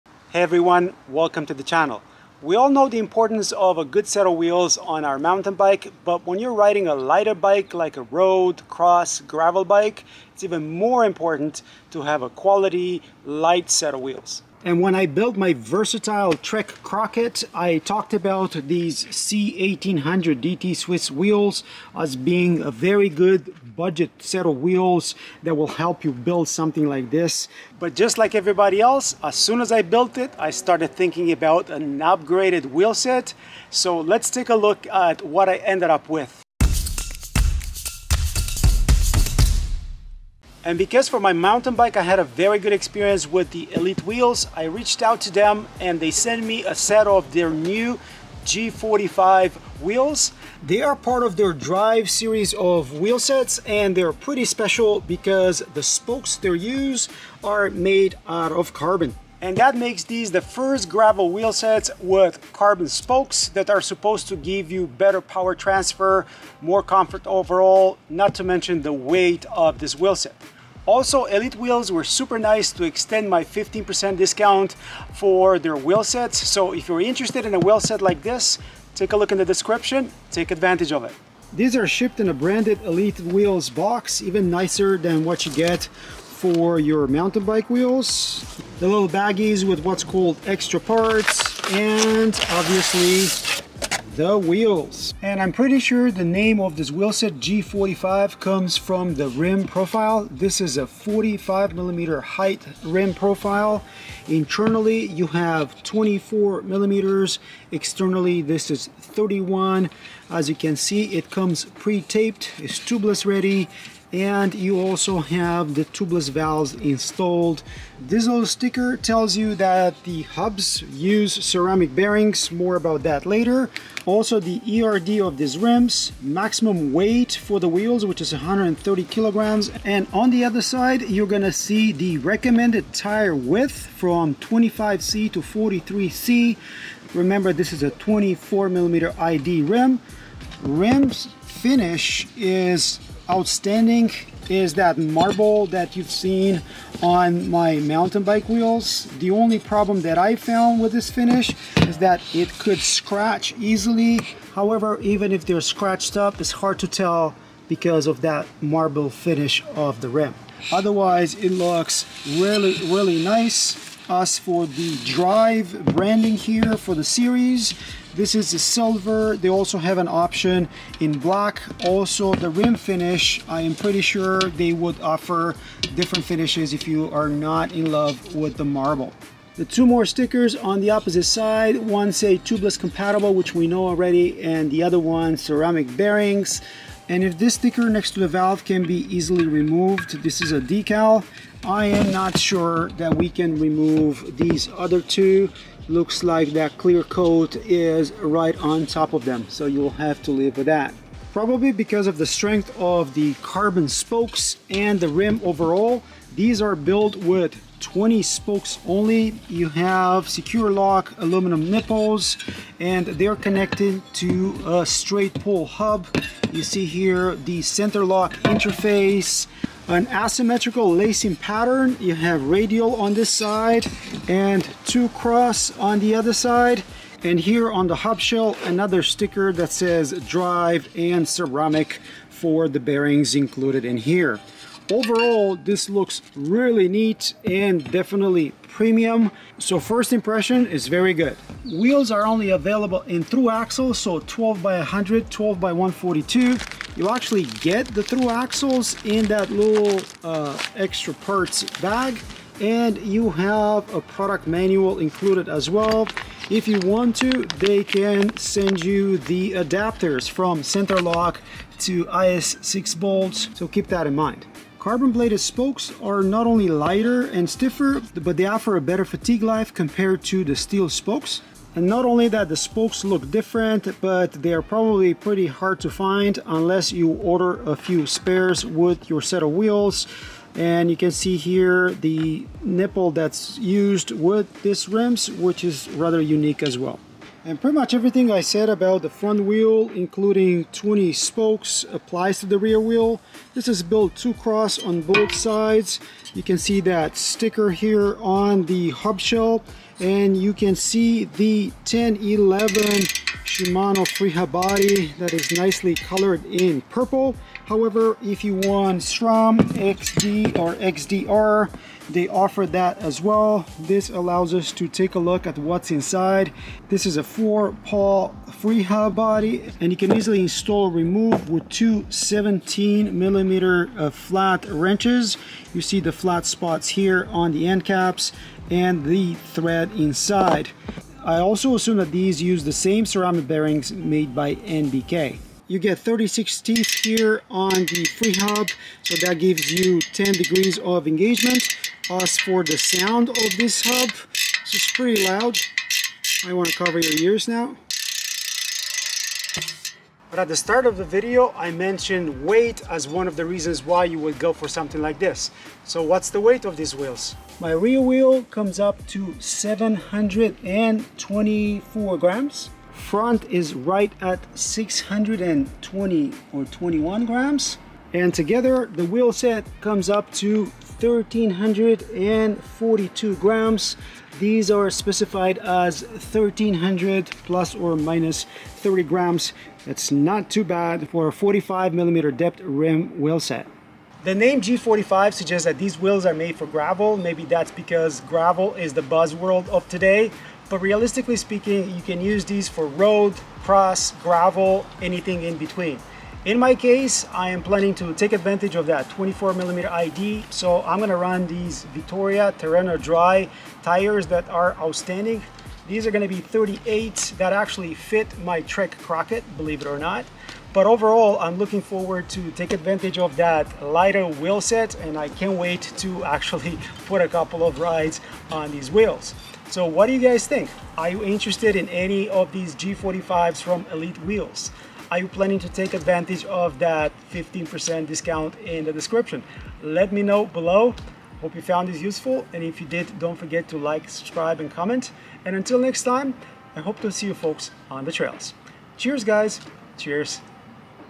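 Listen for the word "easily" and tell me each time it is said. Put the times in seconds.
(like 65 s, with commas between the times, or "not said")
153 s, 189 s, 320 s.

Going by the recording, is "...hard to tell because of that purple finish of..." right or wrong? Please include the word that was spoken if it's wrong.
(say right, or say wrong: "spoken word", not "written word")
wrong: "marble", not "purple".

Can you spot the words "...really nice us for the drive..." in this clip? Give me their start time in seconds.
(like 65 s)
162 s.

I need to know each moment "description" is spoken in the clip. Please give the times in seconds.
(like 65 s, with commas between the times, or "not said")
79 s, 428 s.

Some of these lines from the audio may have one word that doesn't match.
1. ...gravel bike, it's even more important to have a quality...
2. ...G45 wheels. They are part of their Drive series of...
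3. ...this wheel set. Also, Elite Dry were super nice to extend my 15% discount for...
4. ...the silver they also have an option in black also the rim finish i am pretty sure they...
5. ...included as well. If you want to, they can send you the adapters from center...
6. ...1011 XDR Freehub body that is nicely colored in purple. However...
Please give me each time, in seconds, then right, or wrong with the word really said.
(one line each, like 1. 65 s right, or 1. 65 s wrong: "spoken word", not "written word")
1. 9 s right
2. 48 s right
3. 69 s wrong: "Wheels", not "Dry"
4. 168 s right
5. 254 s right
6. 301 s wrong: "Shimano", not "XDR".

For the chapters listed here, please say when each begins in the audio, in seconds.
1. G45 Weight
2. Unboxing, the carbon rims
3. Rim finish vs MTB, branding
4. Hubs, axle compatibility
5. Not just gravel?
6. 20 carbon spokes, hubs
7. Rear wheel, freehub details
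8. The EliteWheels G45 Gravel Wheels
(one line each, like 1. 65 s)
1. 350 s
2. 81 s
3. 140 s
4. 241 s
5. 383 s
6. 201 s
7. 287 s
8. 41 s.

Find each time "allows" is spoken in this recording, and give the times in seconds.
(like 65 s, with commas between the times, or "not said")
314 s.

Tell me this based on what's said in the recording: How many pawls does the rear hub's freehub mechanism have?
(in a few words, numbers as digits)
4.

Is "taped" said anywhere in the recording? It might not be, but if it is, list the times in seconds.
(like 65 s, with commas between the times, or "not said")
111 s.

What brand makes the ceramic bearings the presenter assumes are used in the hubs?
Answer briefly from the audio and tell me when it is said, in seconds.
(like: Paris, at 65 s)
NBK, at 334 s.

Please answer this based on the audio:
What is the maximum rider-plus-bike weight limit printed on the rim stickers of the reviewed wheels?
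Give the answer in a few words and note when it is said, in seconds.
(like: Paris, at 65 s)
130 kilograms, at 128 s.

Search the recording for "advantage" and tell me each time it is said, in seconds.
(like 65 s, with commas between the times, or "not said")
80 s, 398 s, 412 s, 425 s.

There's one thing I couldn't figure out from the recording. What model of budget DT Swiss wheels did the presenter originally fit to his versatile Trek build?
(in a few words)
C1800.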